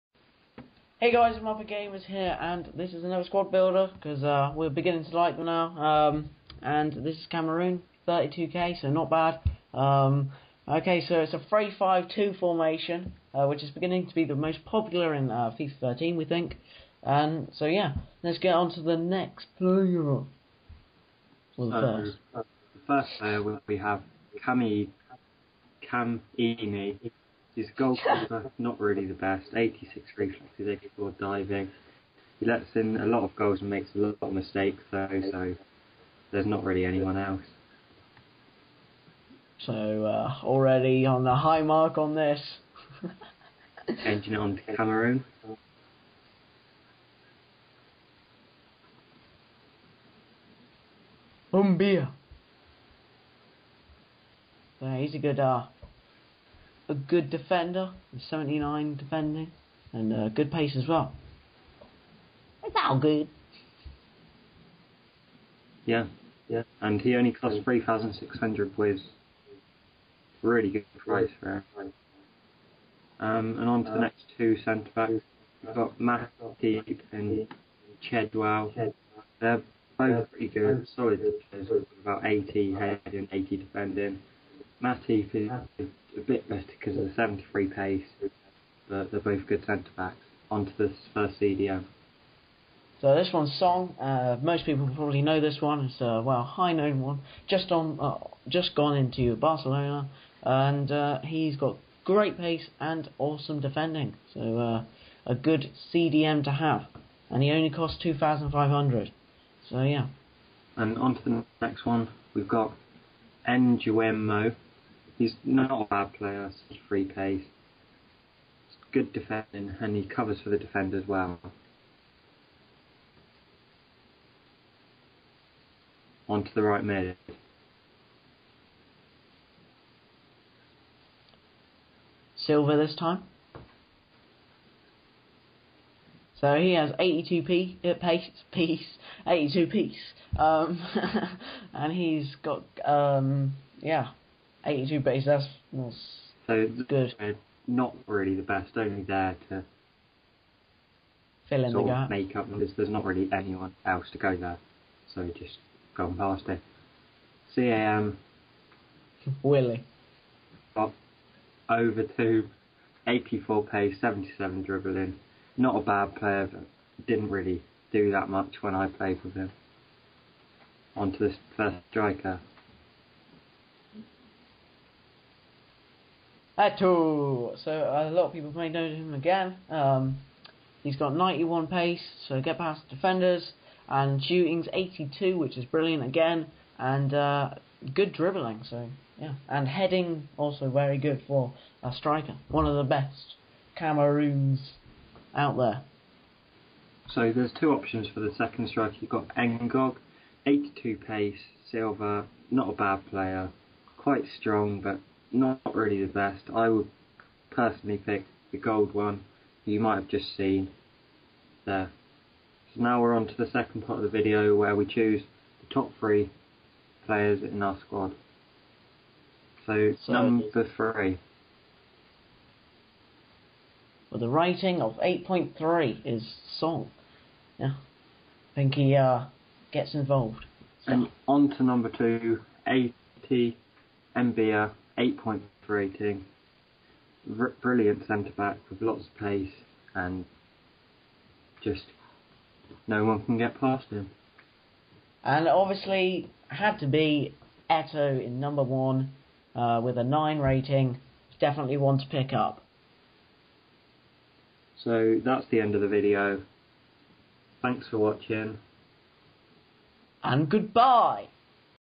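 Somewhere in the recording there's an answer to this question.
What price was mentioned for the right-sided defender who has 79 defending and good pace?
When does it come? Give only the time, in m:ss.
1:07.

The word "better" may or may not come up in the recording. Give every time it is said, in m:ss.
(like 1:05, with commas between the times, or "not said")
1:26.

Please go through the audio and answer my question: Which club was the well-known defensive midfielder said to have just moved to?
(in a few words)
Barcelona.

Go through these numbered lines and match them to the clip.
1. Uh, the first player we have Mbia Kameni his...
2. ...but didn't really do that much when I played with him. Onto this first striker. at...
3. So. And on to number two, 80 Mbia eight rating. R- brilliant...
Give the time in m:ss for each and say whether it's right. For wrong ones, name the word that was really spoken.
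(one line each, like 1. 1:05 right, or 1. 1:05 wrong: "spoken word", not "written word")
1. 0:22 wrong: "Kami", not "Mbia"
2. 2:46 right
3. 3:50 right.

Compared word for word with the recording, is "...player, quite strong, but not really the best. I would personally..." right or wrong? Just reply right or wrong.
right.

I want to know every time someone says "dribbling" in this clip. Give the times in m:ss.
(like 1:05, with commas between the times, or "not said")
2:44, 3:08.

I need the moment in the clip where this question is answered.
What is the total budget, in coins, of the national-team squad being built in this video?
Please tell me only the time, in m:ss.
0:08.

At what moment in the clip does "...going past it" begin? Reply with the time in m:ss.
2:35.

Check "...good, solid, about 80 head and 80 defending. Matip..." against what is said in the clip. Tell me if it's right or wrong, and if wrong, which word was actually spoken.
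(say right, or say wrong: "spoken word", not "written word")
right.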